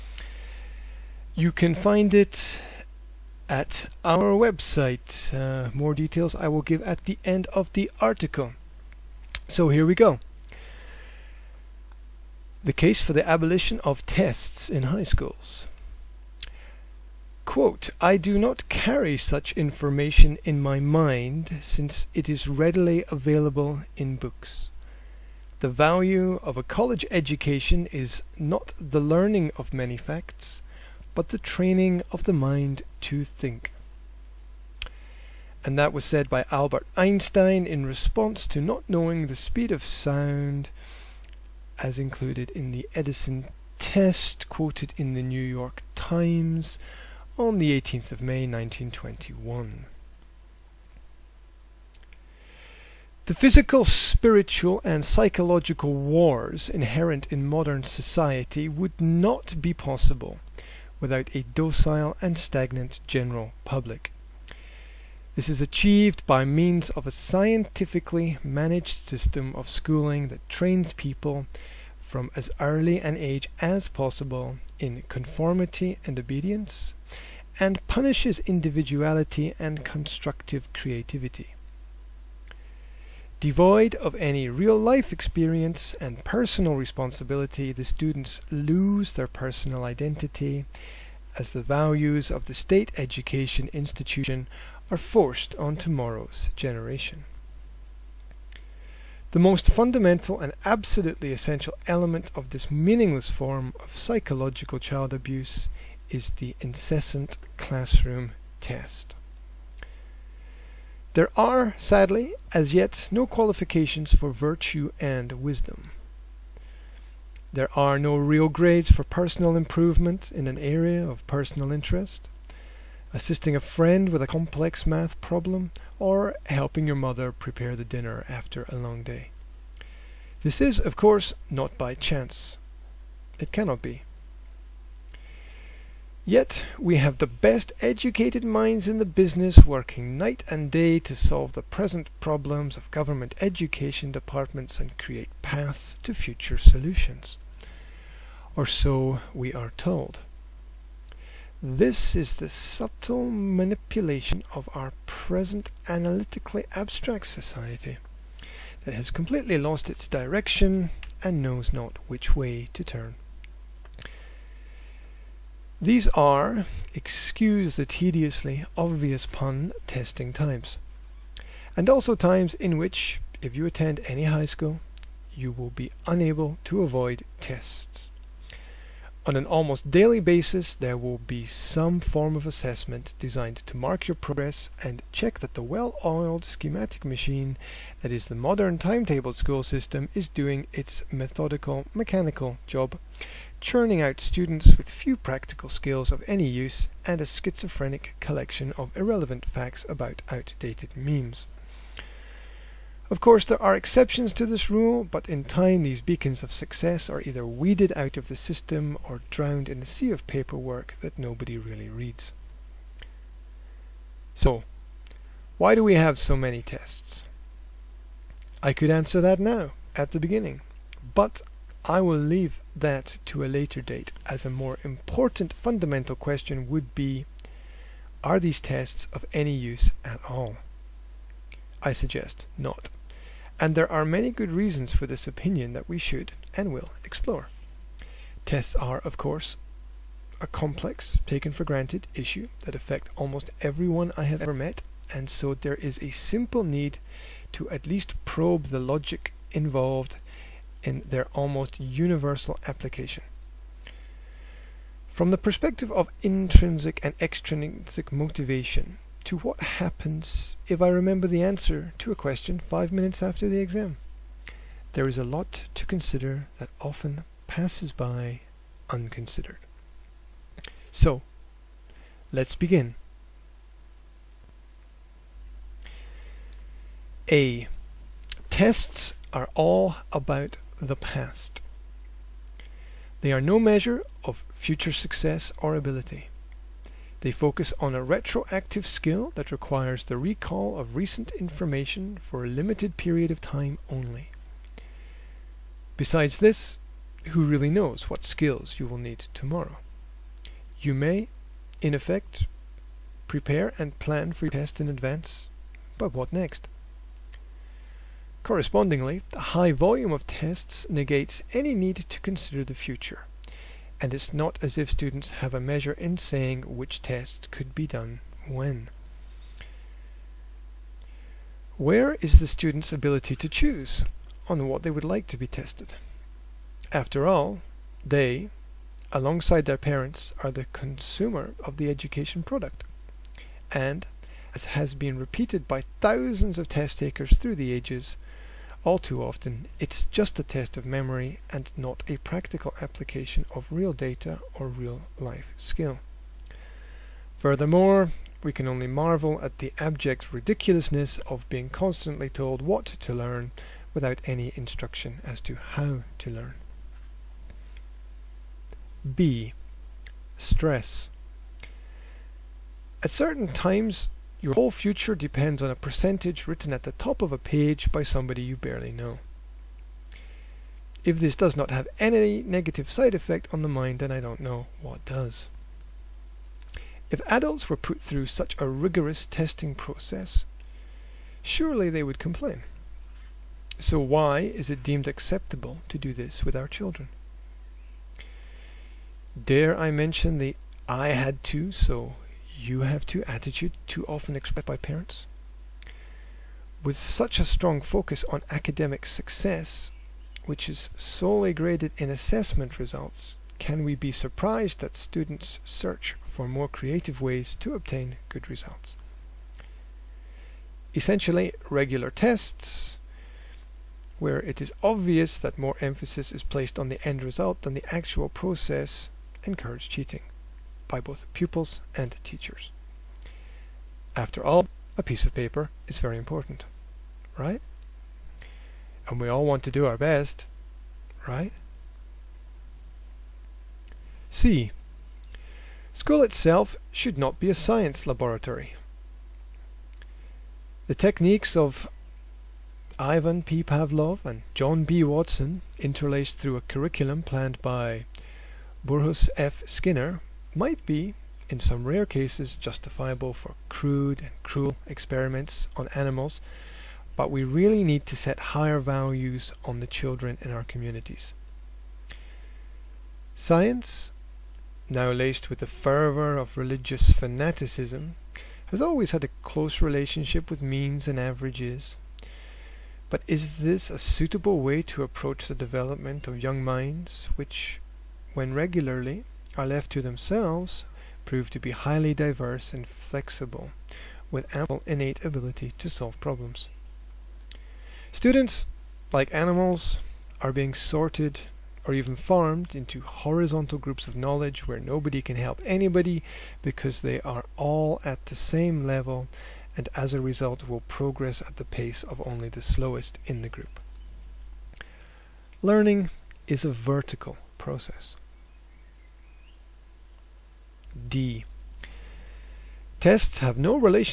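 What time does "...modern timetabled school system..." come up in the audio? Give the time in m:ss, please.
3:08.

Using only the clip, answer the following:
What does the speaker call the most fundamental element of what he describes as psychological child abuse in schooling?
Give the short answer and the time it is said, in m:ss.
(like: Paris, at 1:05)
classroom test, at 1:47.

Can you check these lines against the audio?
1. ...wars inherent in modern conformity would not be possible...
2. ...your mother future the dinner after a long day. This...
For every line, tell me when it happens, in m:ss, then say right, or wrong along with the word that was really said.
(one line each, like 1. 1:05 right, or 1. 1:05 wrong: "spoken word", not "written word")
1. 0:55 wrong: "society", not "conformity"
2. 2:06 wrong: "prepare", not "future".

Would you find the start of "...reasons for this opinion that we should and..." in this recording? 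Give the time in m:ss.
3:54.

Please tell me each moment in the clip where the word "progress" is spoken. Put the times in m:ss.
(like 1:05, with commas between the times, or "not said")
3:04, 8:20.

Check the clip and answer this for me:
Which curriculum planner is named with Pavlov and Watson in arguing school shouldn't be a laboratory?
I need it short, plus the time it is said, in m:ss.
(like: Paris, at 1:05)
Burrhus F. Skinner, at 7:28.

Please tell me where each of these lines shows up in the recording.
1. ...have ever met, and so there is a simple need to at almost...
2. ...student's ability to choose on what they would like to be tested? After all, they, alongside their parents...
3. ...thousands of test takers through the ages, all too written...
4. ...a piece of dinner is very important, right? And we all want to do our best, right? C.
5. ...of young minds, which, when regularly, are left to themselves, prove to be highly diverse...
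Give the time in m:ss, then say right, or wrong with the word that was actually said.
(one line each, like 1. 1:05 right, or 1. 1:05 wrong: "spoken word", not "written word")
1. 4:04 wrong: "least", not "almost"
2. 5:22 right
3. 5:36 wrong: "often", not "written"
4. 7:04 wrong: "paper", not "dinner"
5. 7:56 right.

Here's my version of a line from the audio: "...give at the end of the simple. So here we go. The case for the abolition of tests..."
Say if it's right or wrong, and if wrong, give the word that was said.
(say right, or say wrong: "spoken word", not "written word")
wrong: "article", not "simple".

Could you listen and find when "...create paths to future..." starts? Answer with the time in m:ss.
2:24.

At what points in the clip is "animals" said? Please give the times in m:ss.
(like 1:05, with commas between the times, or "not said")
7:35, 8:09.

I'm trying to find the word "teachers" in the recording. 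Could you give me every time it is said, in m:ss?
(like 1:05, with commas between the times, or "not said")
7:02.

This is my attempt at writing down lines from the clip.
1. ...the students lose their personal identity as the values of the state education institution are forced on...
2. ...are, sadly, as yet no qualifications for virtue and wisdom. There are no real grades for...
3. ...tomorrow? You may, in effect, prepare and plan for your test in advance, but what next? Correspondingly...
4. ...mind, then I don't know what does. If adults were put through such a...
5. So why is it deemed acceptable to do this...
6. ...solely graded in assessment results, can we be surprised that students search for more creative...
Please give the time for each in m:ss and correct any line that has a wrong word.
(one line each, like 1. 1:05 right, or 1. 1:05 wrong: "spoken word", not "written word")
1. 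1:27 right
2. 1:51 right
3. 4:59 right
4. 6:13 right
5. 6:23 right
6. 6:40 right.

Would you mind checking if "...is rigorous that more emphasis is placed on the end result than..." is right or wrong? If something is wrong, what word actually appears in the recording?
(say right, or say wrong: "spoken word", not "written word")
wrong: "obvious", not "rigorous".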